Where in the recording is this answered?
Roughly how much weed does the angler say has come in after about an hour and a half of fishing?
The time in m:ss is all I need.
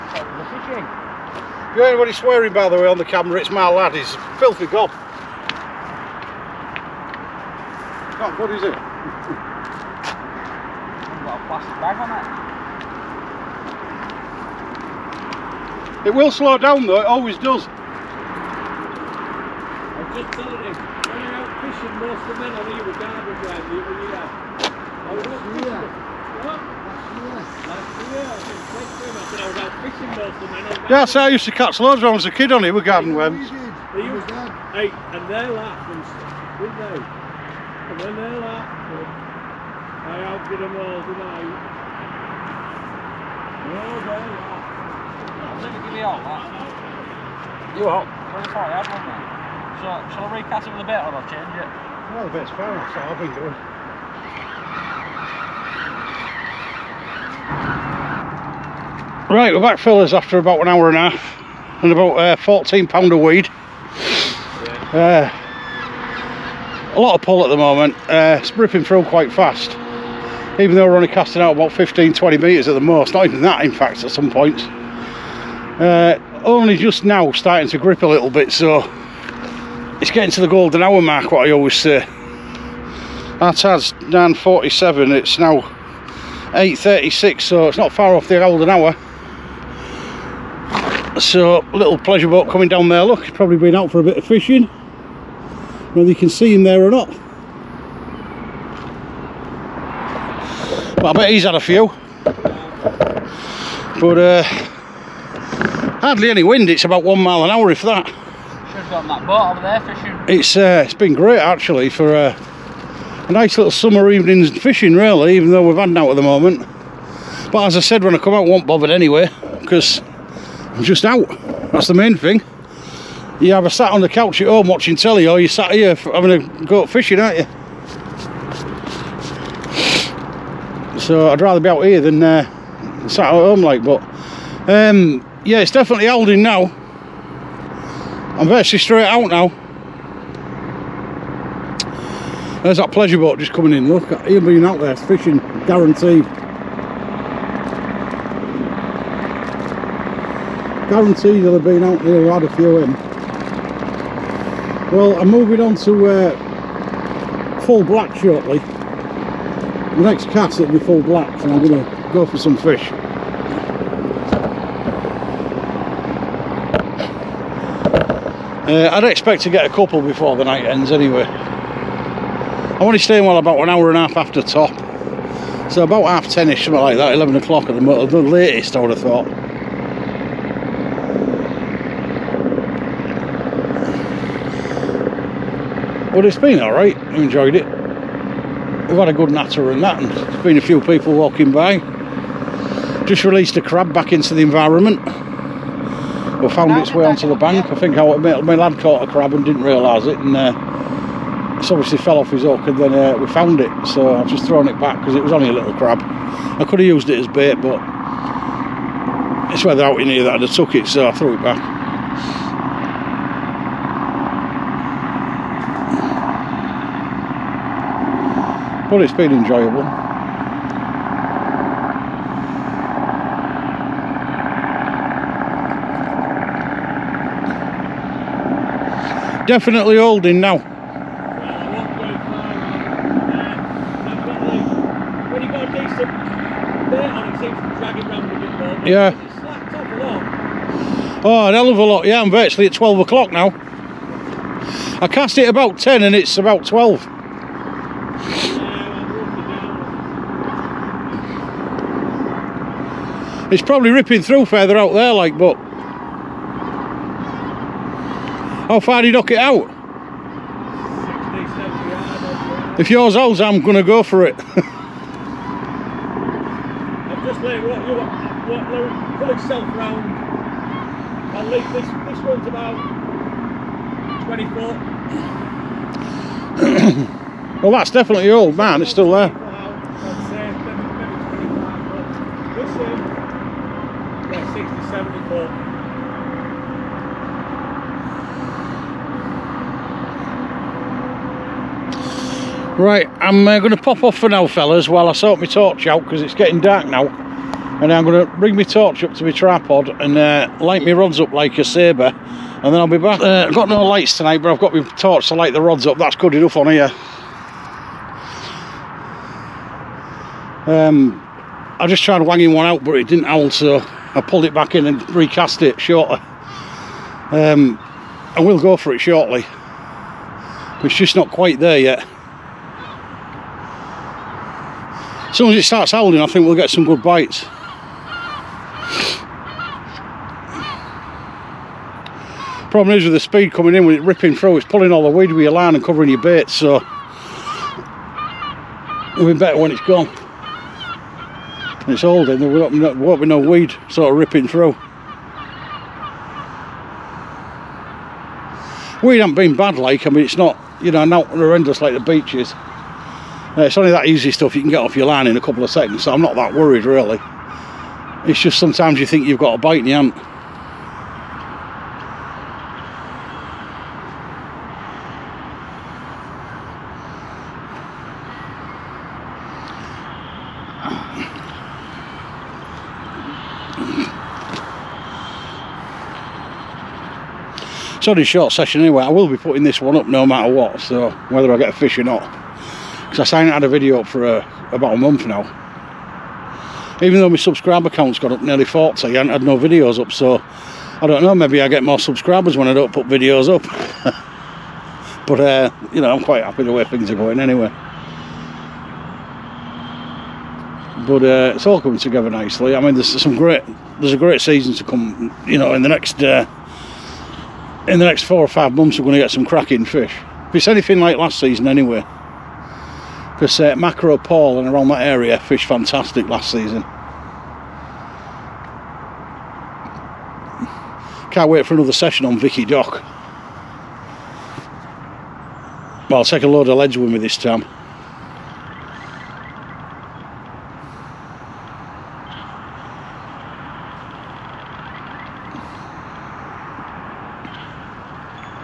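1:02.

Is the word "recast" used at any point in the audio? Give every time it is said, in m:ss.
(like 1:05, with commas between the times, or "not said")
0:50, 5:15.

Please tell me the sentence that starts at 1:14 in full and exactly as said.
Uh, only just now starting to grip a little bit so it's getting to the golden hour mark what I always say.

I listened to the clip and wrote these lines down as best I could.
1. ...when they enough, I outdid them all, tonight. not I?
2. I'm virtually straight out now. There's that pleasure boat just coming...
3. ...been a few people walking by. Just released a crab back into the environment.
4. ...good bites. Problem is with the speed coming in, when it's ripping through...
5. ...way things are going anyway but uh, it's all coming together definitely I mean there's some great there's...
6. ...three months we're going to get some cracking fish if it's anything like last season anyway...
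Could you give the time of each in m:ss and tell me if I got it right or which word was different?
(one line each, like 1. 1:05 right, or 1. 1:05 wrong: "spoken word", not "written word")
1. 0:38 wrong: "laugh", not "enough"
2. 2:18 right
3. 3:10 right
4. 5:26 right
5. 6:36 wrong: "nicely", not "definitely"
6. 6:48 wrong: "five", not "three".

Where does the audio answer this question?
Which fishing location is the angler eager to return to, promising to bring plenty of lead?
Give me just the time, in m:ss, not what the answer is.
7:02.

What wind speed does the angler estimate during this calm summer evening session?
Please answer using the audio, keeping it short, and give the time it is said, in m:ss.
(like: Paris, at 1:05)
1 mile an hour, at 1:47.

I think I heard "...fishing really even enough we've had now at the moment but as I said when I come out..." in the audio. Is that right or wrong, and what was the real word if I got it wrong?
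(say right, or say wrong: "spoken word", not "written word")
wrong: "though", not "enough".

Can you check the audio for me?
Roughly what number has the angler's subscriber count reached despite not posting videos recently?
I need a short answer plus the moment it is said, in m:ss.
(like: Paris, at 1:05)
40, at 6:28.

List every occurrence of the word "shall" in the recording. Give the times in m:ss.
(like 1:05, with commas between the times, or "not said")
0:50.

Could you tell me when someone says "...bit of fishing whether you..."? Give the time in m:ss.
1:34.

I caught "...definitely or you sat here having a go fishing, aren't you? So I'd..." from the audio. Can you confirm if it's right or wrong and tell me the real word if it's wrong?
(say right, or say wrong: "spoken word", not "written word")
wrong: "telly", not "definitely".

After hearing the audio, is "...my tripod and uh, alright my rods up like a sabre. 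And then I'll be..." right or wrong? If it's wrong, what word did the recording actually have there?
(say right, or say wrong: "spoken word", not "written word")
wrong: "light", not "alright".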